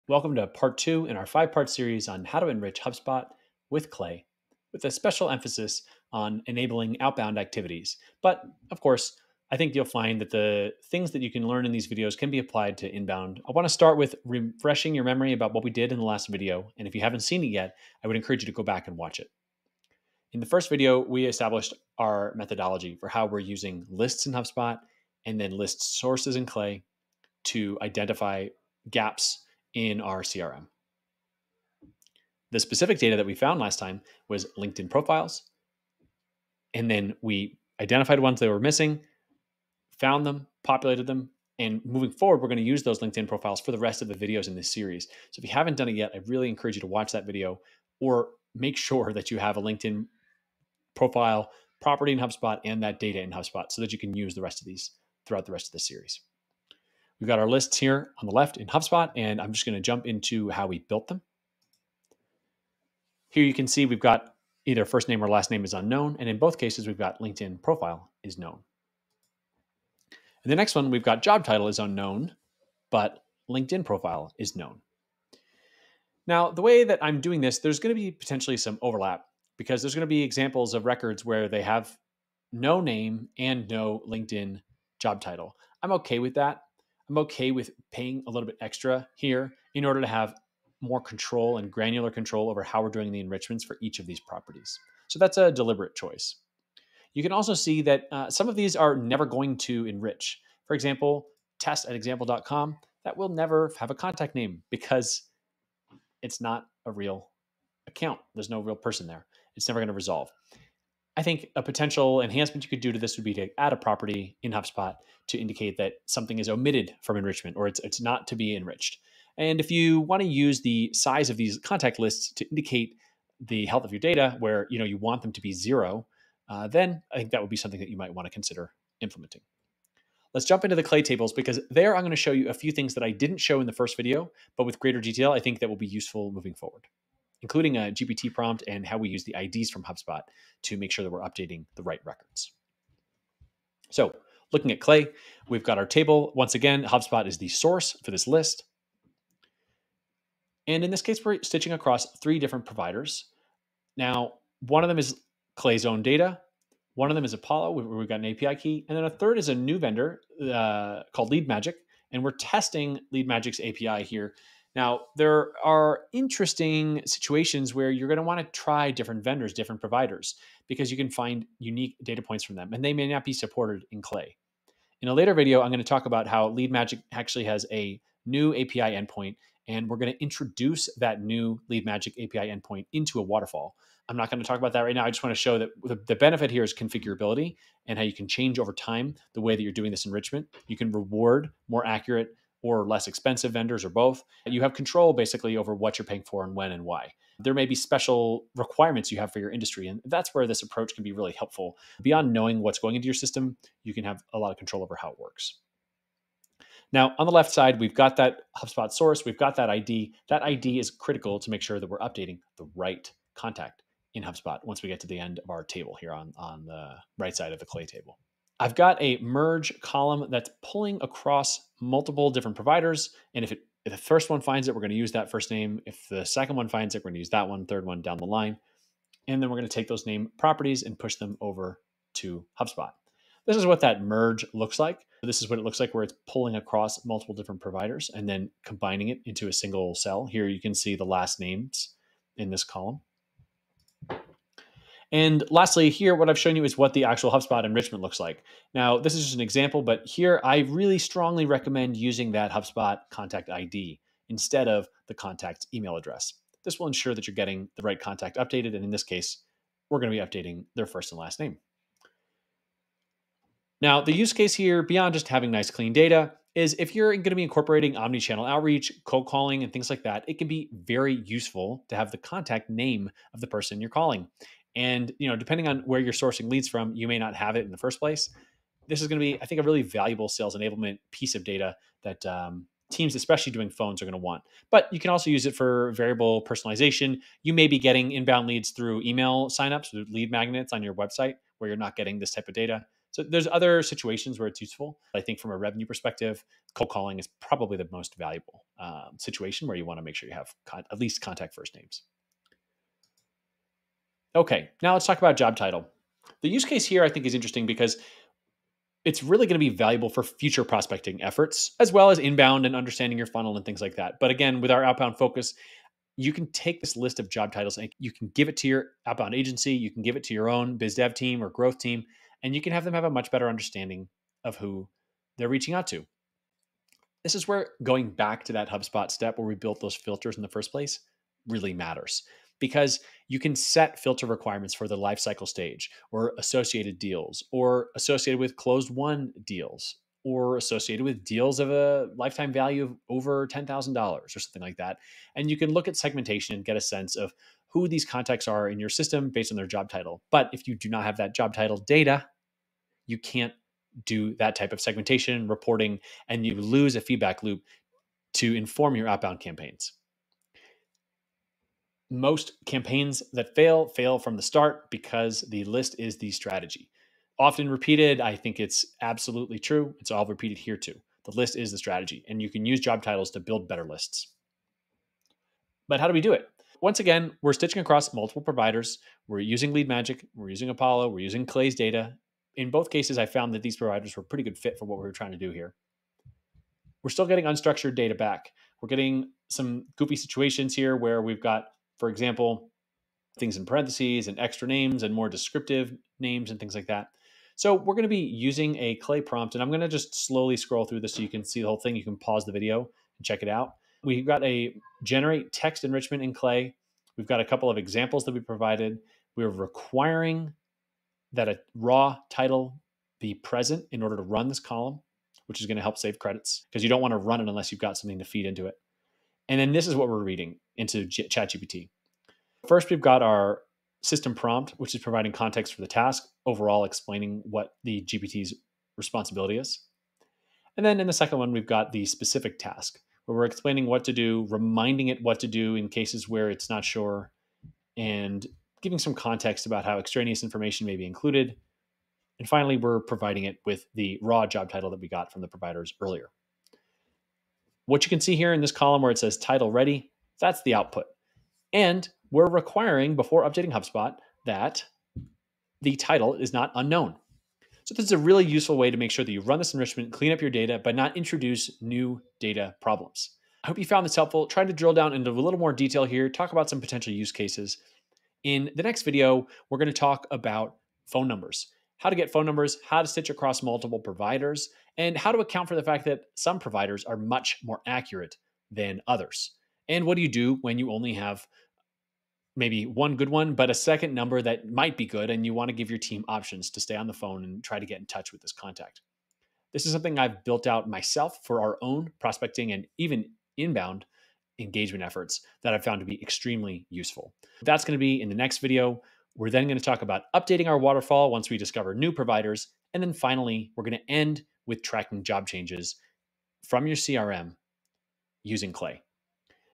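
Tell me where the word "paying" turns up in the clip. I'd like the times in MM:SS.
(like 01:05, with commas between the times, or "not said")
01:27, 03:16.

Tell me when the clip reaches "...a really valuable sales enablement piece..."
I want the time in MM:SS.
04:39.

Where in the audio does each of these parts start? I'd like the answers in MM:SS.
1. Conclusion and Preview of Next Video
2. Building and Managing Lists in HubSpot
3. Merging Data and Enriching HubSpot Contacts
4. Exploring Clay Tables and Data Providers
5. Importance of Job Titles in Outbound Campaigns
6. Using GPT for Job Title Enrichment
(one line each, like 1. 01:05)
1. 07:43
2. 00:57
3. 03:30
4. 02:10
5. 05:04
6. 06:37.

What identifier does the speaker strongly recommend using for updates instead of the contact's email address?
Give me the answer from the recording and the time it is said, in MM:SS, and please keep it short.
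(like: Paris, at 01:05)
HubSpot contact ID, at 04:12.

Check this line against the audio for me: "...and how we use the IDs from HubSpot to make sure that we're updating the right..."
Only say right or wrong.
right.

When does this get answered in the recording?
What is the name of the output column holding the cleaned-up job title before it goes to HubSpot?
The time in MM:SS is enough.
07:29.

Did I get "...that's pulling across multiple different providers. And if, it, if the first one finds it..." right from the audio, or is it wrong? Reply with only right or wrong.
right.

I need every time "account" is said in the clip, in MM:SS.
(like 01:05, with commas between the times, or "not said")
01:47, 07:55.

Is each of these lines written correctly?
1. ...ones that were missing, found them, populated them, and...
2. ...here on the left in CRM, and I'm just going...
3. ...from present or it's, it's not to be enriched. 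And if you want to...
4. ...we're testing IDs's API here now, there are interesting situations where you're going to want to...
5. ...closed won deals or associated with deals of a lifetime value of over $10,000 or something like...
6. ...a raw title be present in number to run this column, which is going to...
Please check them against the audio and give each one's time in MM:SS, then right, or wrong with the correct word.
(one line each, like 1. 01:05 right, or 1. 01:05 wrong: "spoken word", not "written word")
1. 00:38 right
2. 00:57 wrong: "HubSpot", not "CRM"
3. 01:57 wrong: "enrichment", not "present"
4. 02:42 wrong: "LeadMagic", not "IDs"
5. 05:38 right
6. 06:51 wrong: "order", not "number".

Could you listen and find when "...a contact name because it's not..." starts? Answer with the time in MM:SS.
01:43.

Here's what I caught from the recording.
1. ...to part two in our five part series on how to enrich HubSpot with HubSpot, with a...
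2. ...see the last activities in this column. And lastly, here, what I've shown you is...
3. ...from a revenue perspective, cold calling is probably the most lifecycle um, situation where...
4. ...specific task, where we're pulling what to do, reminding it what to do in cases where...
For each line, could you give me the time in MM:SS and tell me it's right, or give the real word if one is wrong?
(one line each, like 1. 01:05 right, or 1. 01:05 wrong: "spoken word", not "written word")
1. 00:00 wrong: "Clay", not "HubSpot"
2. 04:00 wrong: "names", not "activities"
3. 04:55 wrong: "valuable", not "lifecycle"
4. 07:12 wrong: "explaining", not "pulling".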